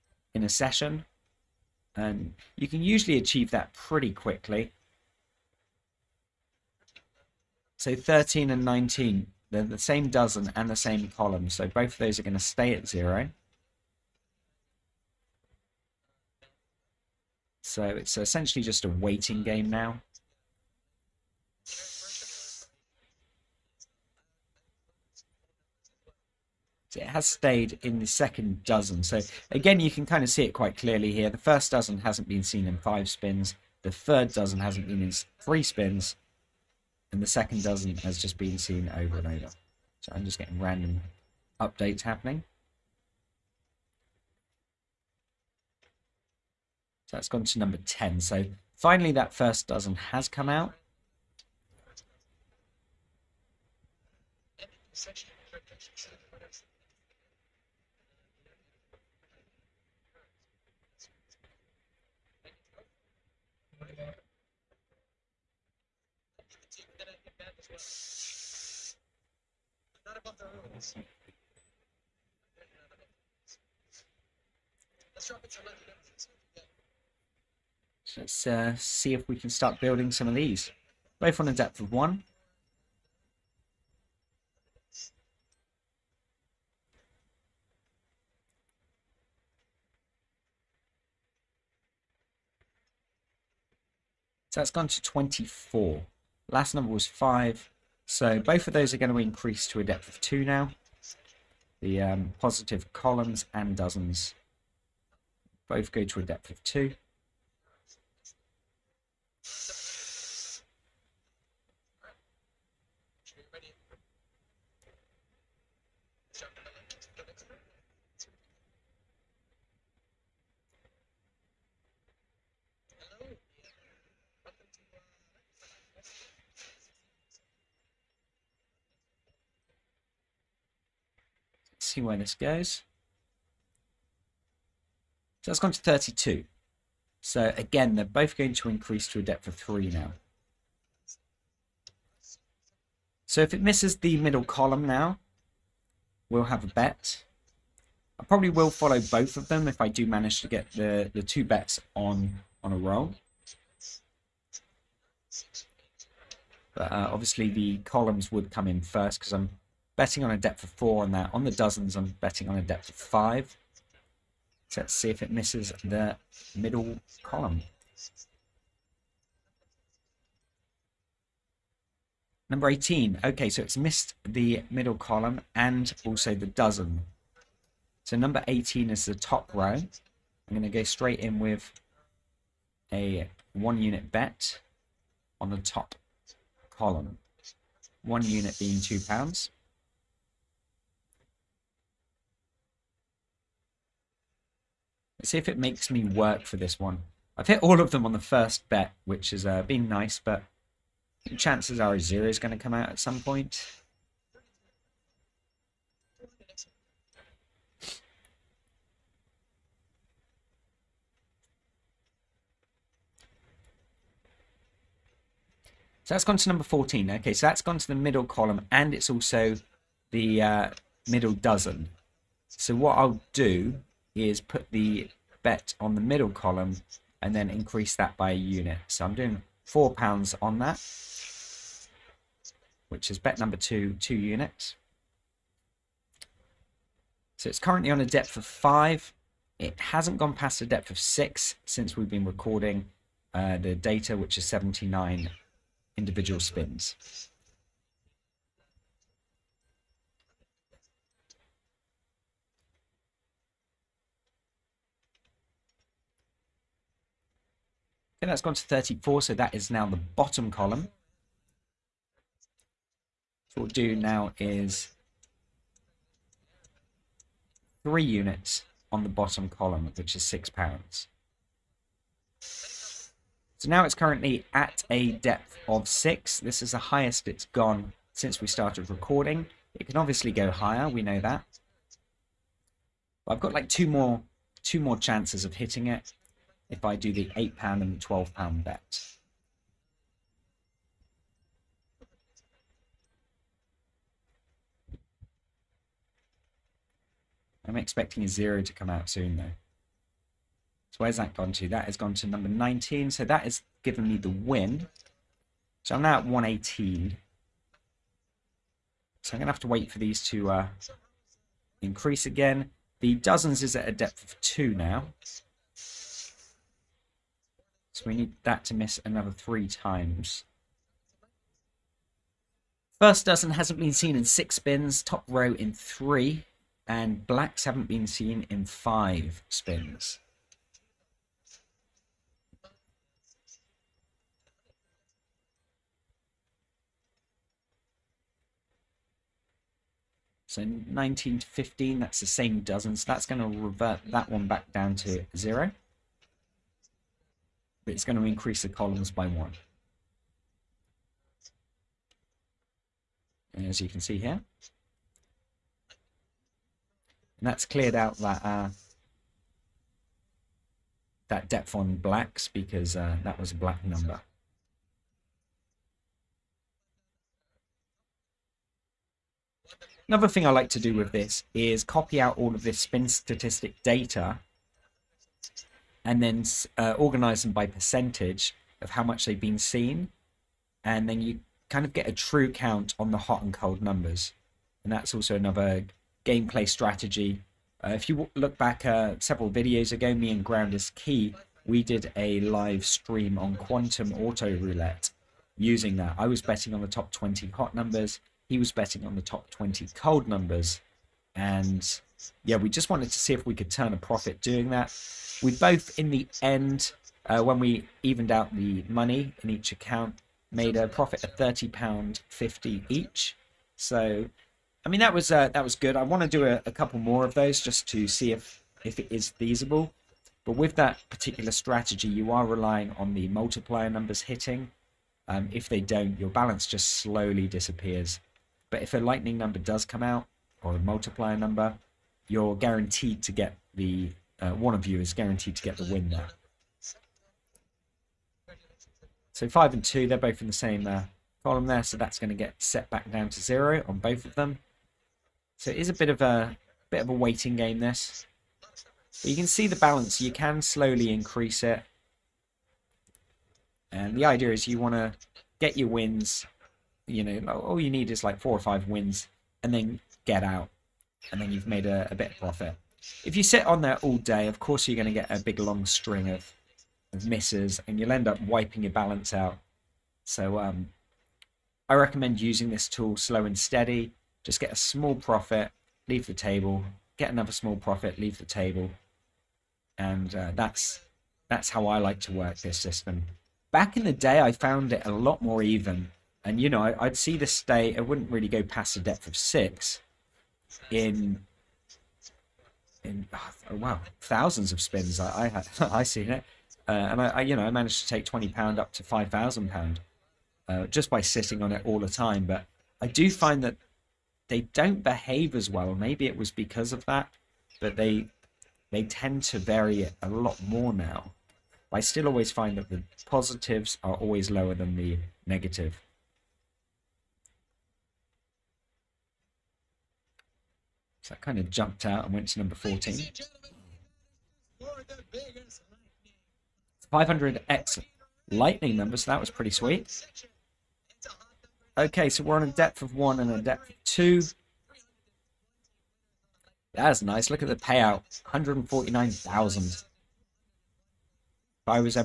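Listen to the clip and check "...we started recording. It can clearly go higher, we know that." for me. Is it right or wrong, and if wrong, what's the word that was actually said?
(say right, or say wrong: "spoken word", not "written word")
wrong: "obviously", not "clearly".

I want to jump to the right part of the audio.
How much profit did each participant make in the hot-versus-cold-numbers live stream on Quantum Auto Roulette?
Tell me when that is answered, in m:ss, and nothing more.
6:51.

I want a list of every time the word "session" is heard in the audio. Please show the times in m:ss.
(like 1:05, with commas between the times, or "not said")
0:00.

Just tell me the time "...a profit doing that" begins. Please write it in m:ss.
6:43.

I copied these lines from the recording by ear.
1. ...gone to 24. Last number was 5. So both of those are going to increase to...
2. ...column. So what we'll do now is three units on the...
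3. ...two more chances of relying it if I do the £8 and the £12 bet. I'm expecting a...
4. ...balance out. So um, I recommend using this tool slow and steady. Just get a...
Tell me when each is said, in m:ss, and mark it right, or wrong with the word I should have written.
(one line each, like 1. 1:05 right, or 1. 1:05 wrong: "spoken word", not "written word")
1. 1:34 right
2. 4:20 right
3. 4:44 wrong: "hitting", not "relying"
4. 7:48 right.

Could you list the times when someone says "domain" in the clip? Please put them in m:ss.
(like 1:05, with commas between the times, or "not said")
not said.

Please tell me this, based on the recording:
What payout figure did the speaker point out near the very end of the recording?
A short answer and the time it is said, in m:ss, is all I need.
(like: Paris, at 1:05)
149,000, at 8:58.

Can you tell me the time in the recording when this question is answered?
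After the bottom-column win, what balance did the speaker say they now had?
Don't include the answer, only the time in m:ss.
5:06.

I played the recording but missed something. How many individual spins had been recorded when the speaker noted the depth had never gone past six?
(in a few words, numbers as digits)
79.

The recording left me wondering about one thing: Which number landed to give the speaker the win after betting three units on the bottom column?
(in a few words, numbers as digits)
19.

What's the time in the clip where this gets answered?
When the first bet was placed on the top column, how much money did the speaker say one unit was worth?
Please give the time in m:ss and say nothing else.
3:08.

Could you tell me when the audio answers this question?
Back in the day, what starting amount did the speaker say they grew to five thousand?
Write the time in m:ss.
8:18.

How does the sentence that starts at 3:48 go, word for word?
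So I'm doing four pounds on that, which is bet number two, two units.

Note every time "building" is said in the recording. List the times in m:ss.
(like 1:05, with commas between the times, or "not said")
1:19.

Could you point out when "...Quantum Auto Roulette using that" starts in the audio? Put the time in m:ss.
6:33.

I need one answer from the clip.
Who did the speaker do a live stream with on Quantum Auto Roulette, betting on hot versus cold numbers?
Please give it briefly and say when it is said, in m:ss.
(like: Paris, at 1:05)
Ground is Key, at 6:30.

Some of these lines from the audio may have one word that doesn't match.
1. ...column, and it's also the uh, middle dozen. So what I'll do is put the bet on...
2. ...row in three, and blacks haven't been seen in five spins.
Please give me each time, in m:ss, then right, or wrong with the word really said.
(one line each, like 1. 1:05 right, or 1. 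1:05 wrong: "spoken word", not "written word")
1. 3:38 right
2. 5:25 right.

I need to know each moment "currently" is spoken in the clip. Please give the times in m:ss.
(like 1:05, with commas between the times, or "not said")
3:57, 4:33.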